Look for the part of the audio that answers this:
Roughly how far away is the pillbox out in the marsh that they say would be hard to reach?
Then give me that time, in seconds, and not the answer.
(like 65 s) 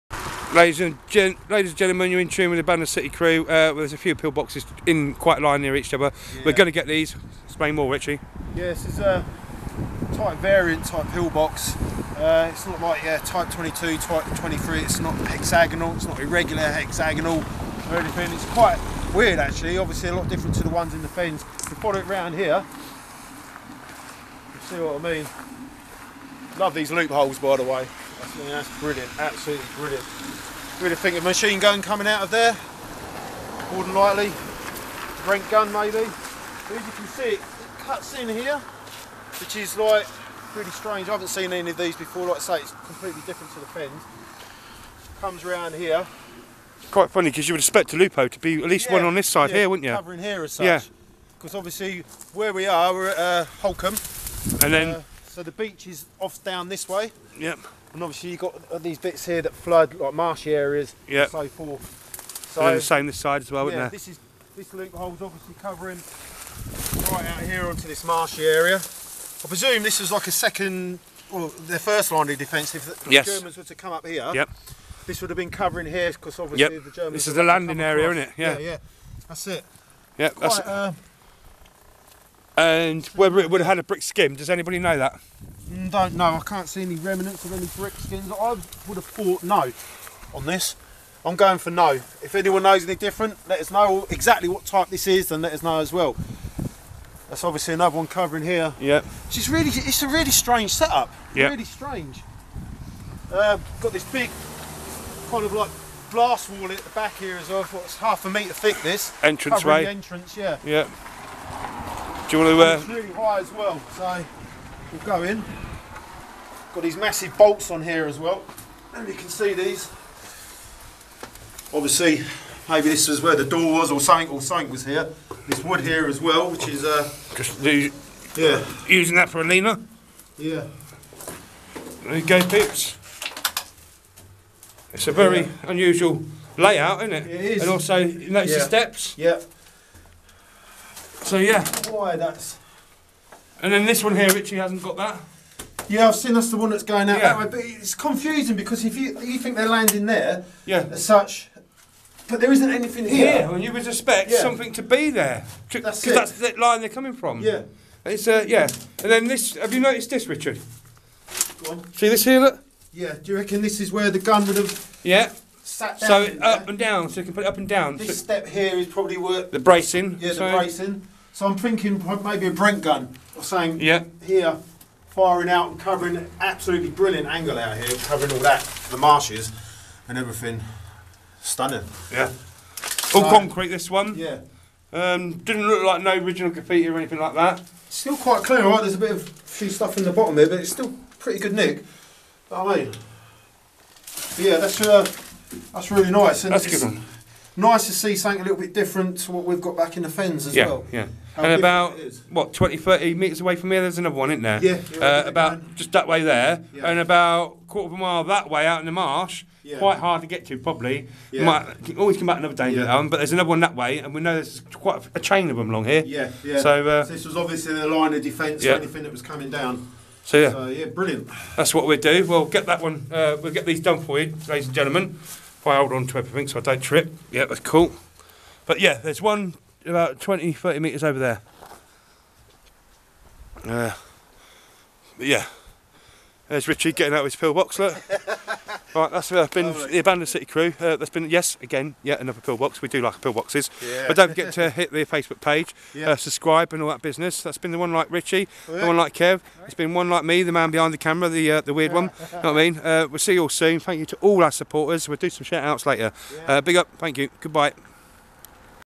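207 s.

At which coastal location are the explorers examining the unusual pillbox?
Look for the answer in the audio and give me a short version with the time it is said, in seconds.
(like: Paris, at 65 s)
Holkham, at 53 s.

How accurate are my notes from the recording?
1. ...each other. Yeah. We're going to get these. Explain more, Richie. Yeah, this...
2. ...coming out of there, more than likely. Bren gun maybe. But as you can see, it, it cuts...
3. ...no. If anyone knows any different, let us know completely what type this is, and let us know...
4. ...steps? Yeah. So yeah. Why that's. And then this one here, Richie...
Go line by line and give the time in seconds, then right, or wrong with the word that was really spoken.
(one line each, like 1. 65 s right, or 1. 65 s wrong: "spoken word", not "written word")
1. 5 s right
2. 31 s right
3. 91 s wrong: "exactly", not "completely"
4. 138 s right.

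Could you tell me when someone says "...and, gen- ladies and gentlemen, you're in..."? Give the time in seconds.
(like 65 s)
0 s.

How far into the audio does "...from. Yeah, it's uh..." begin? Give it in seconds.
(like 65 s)
157 s.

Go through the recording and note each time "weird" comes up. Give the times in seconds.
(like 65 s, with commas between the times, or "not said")
19 s, 251 s.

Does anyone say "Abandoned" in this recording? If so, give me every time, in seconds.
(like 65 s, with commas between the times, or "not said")
2 s, 239 s.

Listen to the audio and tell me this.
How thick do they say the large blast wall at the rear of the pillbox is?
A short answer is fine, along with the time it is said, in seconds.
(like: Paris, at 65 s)
half a metre, at 107 s.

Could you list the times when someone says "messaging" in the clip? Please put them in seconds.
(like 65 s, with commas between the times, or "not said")
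not said.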